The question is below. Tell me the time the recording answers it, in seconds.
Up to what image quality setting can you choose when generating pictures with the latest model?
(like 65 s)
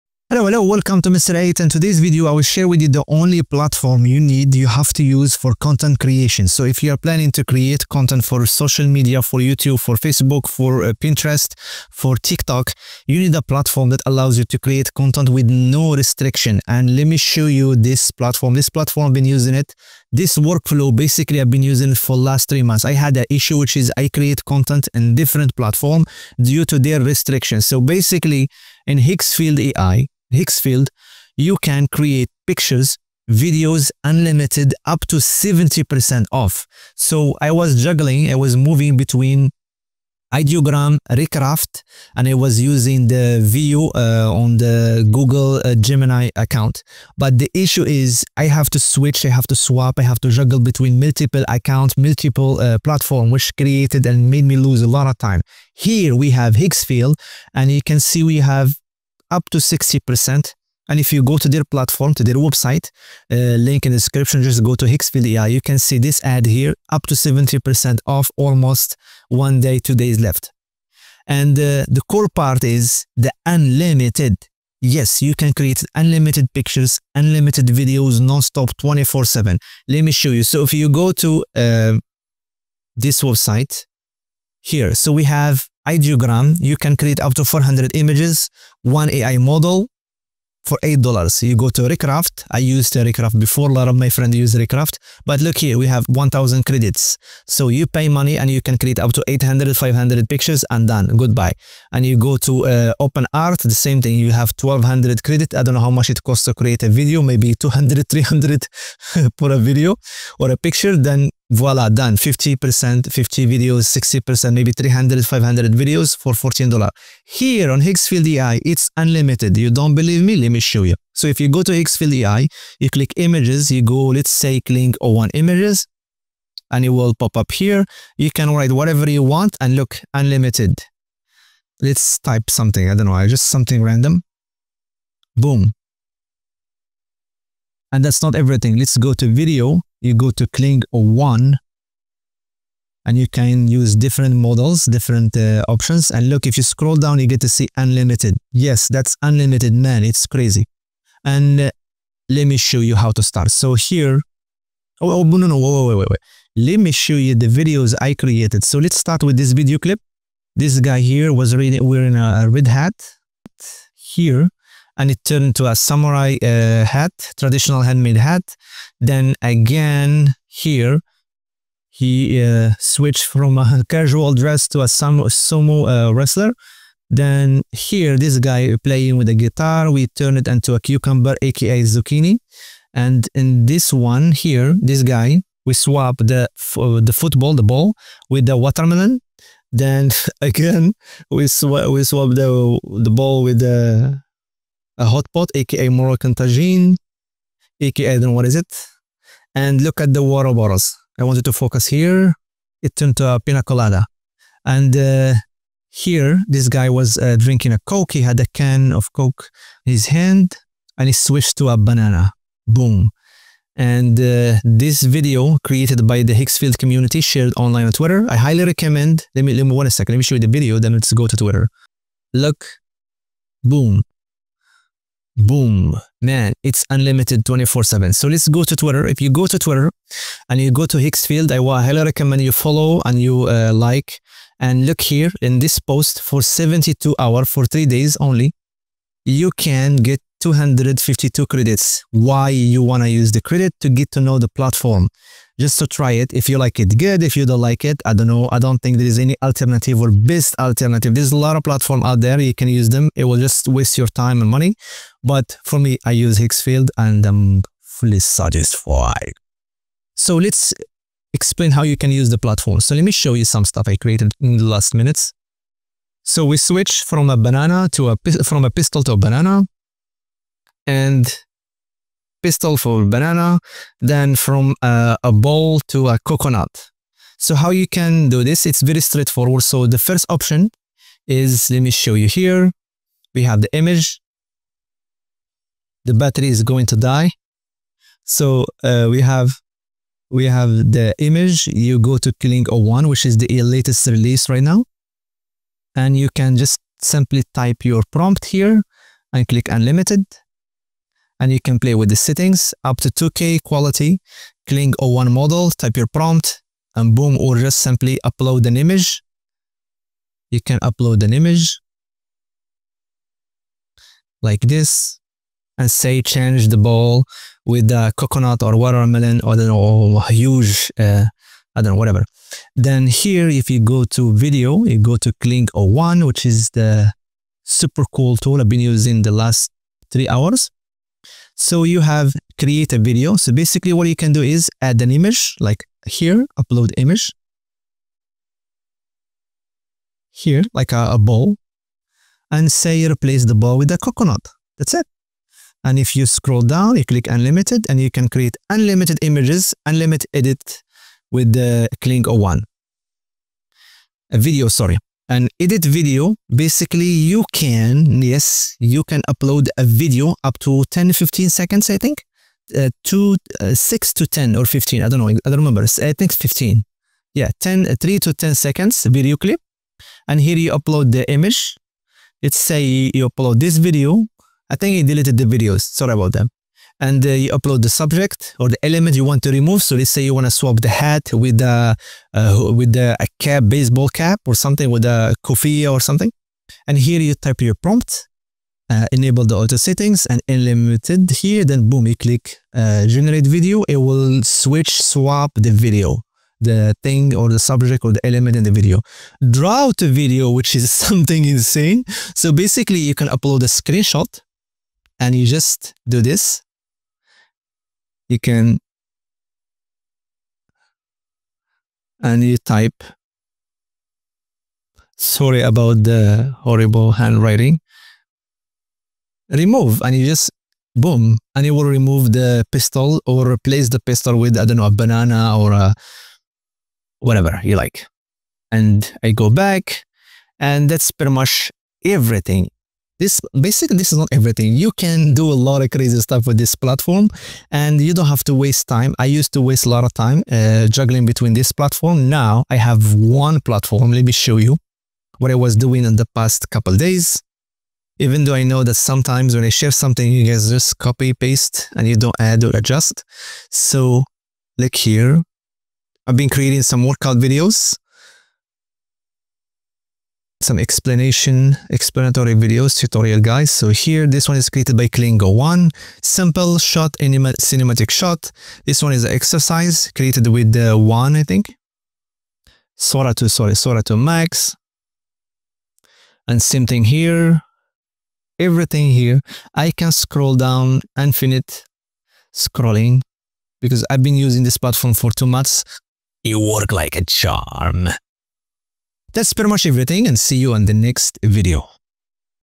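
303 s.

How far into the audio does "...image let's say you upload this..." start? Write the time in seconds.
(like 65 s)
371 s.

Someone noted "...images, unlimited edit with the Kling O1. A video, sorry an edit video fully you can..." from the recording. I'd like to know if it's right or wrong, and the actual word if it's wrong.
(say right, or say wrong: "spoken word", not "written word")
wrong: "basically", not "fully".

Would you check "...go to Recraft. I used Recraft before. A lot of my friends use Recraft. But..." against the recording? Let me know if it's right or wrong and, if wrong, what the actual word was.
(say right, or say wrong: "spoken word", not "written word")
right.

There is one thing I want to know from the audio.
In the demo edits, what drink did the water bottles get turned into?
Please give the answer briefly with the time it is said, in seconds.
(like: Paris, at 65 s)
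Pina colada, at 203 s.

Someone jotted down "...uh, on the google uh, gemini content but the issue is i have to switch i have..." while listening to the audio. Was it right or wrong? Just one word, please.
wrong.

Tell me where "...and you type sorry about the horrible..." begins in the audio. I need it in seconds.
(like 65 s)
412 s.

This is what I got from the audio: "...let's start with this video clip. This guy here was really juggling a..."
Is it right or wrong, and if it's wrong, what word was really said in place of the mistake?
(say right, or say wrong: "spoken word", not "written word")
wrong: "wearing", not "juggling".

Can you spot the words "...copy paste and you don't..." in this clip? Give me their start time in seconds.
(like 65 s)
450 s.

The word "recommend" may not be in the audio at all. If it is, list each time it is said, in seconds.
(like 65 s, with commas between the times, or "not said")
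218 s, 232 s.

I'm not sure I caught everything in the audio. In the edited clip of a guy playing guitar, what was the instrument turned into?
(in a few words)
A cucumber.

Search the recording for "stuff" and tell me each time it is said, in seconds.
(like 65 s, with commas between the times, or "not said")
263 s, 436 s.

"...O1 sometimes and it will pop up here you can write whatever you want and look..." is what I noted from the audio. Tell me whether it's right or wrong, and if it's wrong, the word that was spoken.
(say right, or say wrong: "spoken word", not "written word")
wrong: "images", not "sometimes".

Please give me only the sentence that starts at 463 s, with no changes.
So here, this one is created by Kling O1.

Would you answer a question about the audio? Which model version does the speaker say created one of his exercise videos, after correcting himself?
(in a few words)
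Sora 2 Max.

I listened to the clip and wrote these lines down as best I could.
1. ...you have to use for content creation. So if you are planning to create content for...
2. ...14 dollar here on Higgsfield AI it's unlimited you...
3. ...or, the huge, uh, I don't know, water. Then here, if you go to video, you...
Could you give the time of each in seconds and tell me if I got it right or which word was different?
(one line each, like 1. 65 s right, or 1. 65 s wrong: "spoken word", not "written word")
1. 4 s right
2. 116 s right
3. 319 s wrong: "whatever", not "water".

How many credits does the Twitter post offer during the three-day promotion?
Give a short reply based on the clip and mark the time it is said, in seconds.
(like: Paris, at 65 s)
252, at 240 s.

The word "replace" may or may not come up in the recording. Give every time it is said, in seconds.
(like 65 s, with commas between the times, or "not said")
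343 s, 423 s.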